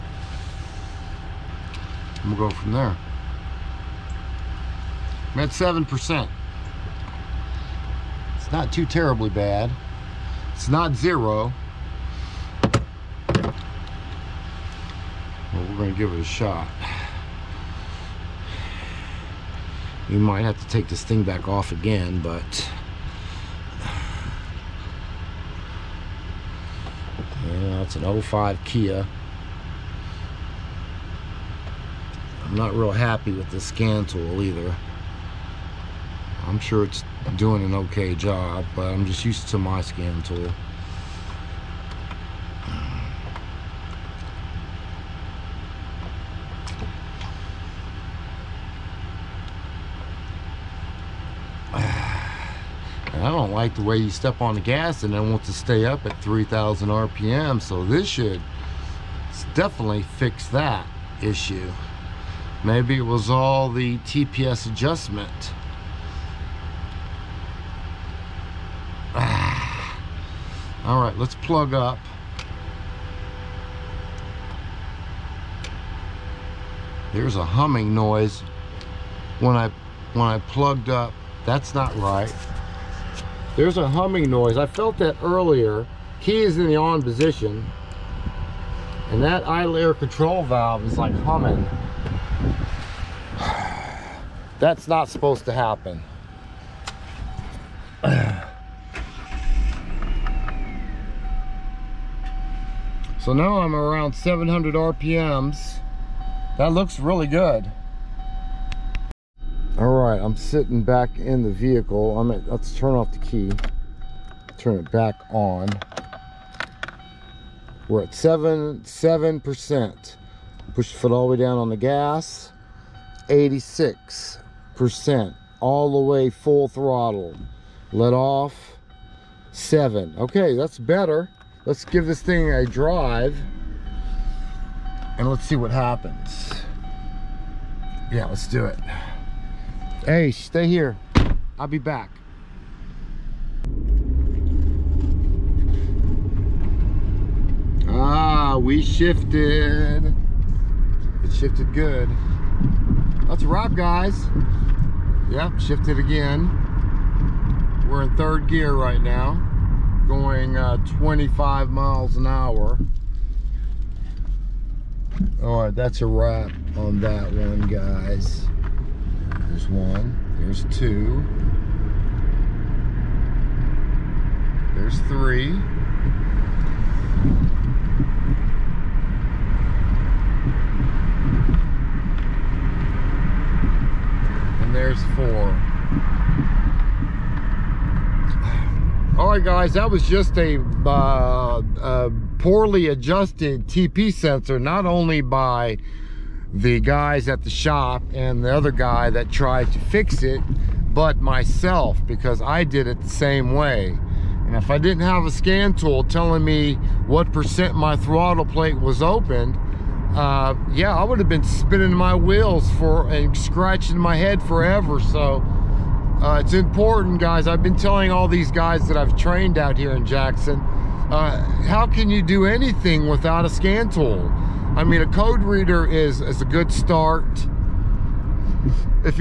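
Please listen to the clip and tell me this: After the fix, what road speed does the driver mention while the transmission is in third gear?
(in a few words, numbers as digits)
25 mph.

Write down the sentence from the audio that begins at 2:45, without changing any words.
All right, that's a wrap on that one, guys.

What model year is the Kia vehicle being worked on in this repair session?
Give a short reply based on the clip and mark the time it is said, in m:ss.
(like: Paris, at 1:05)
2005, at 0:28.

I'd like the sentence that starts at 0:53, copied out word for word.
I don't like the way you step on the gas and then want to stay up at 3,000 RPM.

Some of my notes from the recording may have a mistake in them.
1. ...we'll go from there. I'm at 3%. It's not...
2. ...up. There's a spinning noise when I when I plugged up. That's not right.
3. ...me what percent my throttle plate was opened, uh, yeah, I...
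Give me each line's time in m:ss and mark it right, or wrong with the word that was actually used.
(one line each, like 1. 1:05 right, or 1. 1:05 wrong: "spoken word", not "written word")
1. 0:02 wrong: "7", not "3"
2. 1:11 wrong: "humming", not "spinning"
3. 3:26 right.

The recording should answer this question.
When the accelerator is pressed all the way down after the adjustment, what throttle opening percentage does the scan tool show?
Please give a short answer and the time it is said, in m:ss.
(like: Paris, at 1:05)
86%, at 2:03.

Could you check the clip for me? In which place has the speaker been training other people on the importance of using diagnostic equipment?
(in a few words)
Jackson.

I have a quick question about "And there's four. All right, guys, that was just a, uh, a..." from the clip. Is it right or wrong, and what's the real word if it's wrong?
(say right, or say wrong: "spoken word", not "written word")
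right.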